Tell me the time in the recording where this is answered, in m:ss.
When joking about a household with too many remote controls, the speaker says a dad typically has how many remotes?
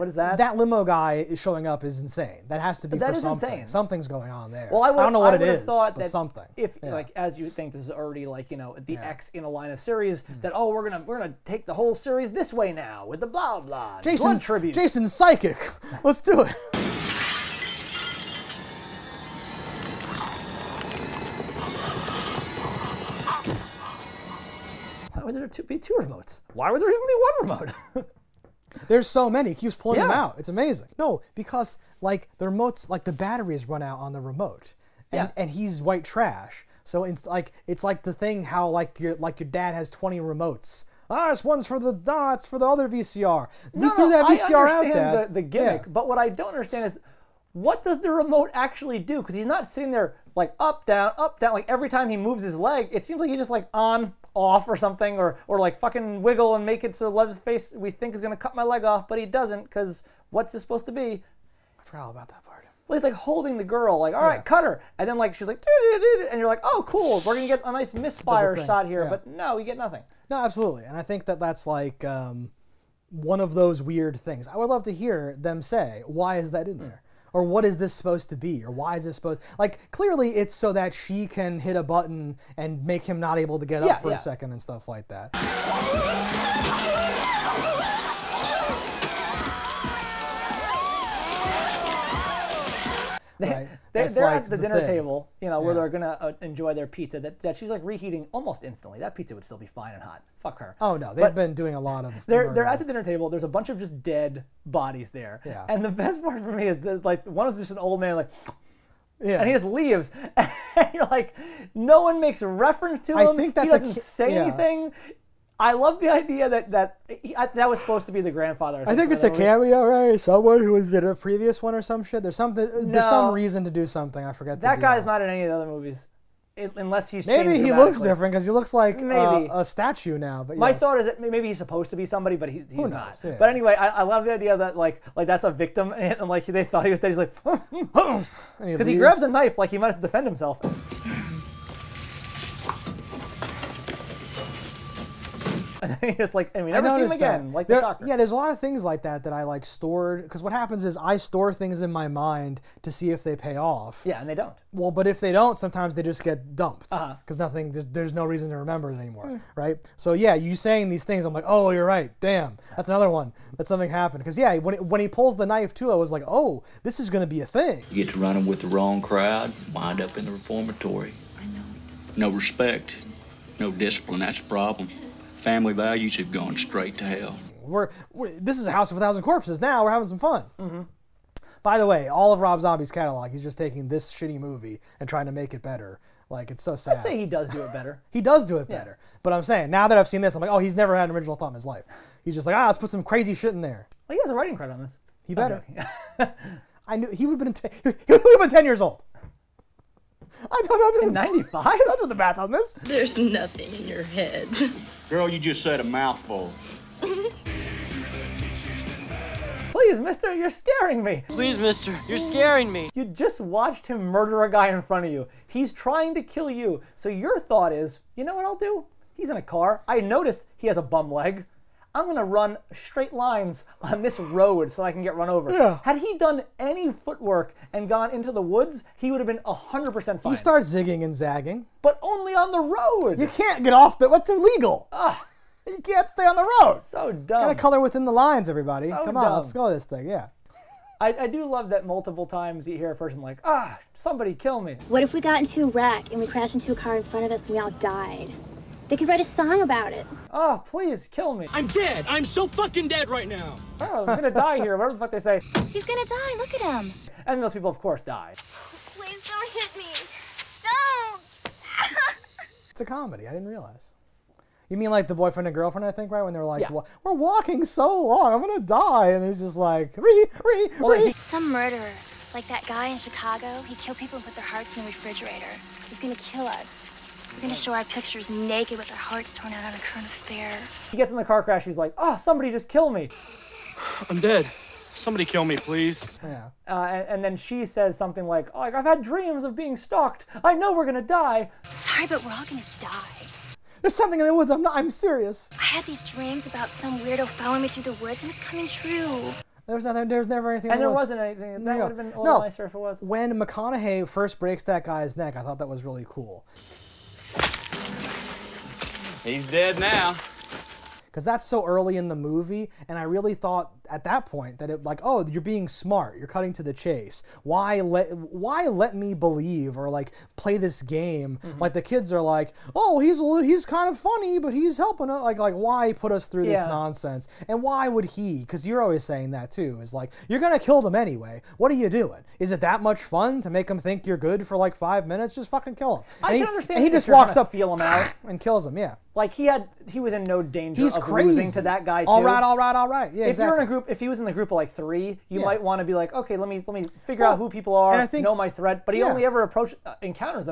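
0:39.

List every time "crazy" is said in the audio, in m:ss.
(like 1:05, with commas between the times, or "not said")
3:13, 5:41.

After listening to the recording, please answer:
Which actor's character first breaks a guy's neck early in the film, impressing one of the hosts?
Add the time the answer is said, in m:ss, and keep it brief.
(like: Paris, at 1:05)
McConaughey, at 5:03.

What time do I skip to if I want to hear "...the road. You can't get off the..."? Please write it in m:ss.
3:52.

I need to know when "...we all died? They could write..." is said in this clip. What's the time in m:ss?
4:07.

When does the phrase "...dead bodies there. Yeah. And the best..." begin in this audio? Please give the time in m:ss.
1:44.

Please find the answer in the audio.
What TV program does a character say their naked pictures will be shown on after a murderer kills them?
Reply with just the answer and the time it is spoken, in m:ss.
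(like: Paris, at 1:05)
A Current Affair, at 4:39.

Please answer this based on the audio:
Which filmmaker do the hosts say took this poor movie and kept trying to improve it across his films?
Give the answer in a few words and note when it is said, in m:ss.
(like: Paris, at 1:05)
Rob Zombie, at 3:02.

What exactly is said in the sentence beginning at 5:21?
like the kids are like oh he's he's kind of funny but he's helping us like like why put us through yeah.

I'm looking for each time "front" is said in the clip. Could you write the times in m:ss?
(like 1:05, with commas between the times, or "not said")
3:34, 4:07.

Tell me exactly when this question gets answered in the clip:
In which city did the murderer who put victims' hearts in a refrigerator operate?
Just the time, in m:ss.
4:32.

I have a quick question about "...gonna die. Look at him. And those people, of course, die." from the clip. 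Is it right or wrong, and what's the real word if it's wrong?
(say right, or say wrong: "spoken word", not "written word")
right.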